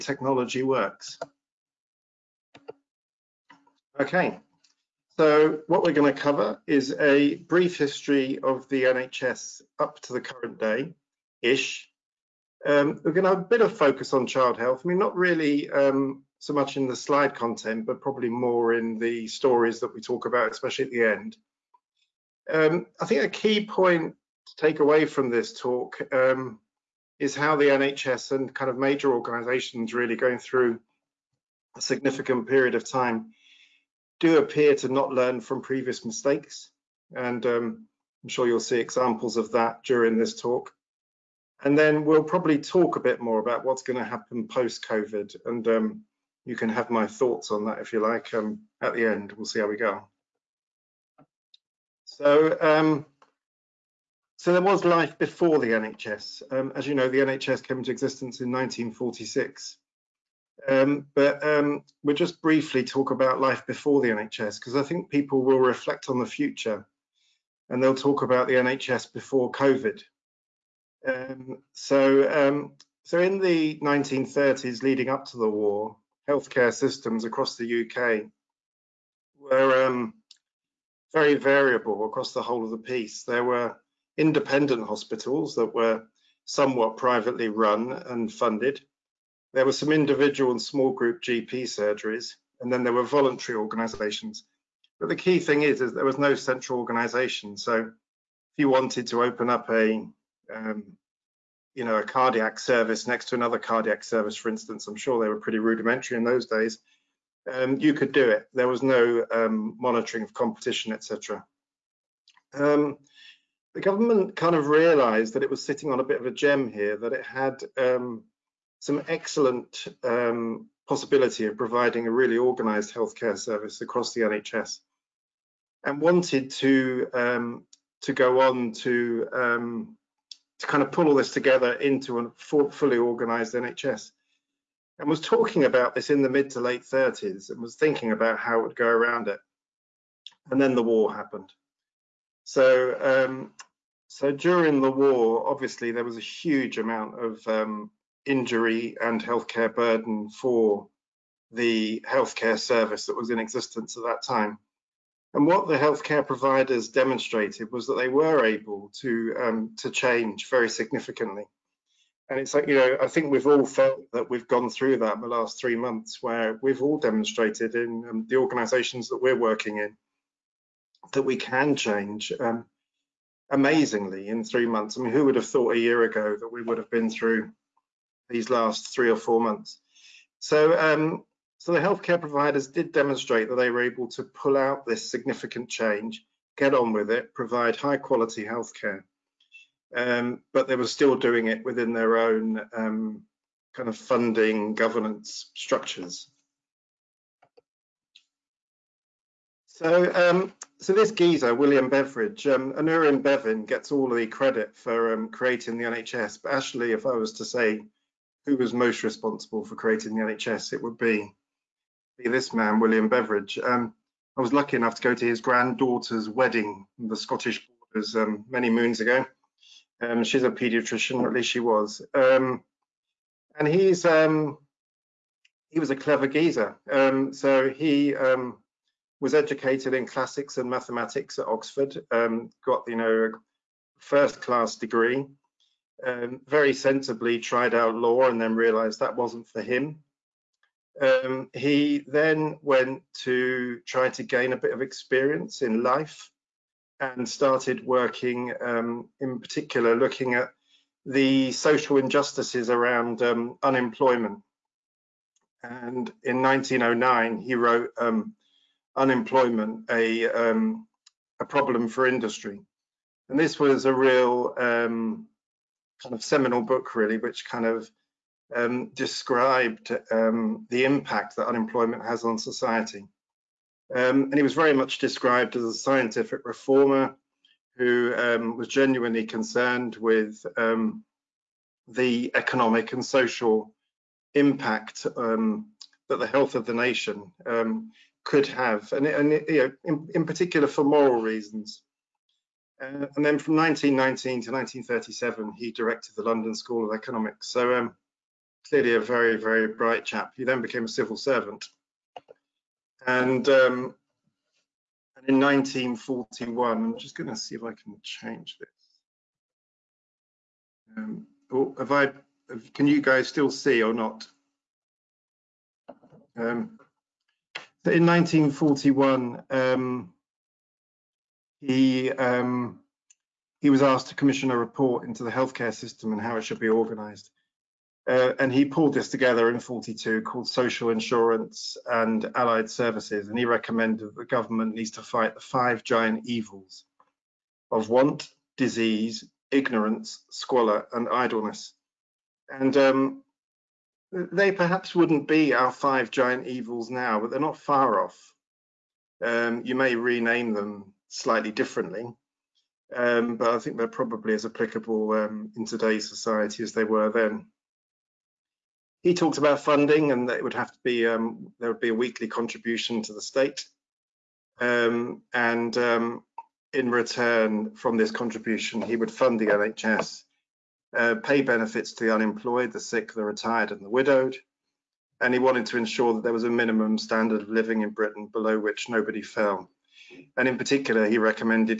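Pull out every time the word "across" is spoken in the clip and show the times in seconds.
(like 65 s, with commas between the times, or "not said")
77 s, 82 s, 123 s.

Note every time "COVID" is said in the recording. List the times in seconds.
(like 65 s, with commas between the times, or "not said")
44 s, 69 s.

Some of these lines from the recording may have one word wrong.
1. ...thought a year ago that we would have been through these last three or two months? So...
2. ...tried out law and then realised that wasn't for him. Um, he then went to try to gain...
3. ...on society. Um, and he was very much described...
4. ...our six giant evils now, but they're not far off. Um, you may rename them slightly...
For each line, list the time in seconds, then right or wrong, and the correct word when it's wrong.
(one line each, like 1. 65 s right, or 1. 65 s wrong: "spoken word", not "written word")
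1. 175 s wrong: "four", not "two"
2. 237 s right
3. 272 s right
4. 345 s wrong: "five", not "six".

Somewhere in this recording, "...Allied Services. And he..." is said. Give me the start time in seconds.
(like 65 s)
332 s.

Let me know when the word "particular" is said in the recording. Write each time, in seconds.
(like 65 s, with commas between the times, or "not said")
249 s, 290 s, 380 s.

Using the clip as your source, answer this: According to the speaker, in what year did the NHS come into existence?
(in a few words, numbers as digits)
1946.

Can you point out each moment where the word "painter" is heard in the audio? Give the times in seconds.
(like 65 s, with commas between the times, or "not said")
not said.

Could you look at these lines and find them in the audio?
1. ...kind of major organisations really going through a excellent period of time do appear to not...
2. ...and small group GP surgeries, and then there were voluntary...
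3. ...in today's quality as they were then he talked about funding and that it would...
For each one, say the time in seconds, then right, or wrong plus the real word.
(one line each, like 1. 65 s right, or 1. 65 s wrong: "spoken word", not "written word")
1. 28 s wrong: "significant", not "excellent"
2. 90 s right
3. 355 s wrong: "society", not "quality".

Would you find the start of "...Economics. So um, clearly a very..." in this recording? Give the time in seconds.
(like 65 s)
296 s.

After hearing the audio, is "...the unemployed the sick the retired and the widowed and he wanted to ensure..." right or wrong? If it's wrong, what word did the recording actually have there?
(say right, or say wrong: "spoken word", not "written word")
right.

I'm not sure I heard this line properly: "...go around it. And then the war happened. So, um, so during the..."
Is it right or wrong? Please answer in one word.
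right.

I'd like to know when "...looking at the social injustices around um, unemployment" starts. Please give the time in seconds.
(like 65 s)
249 s.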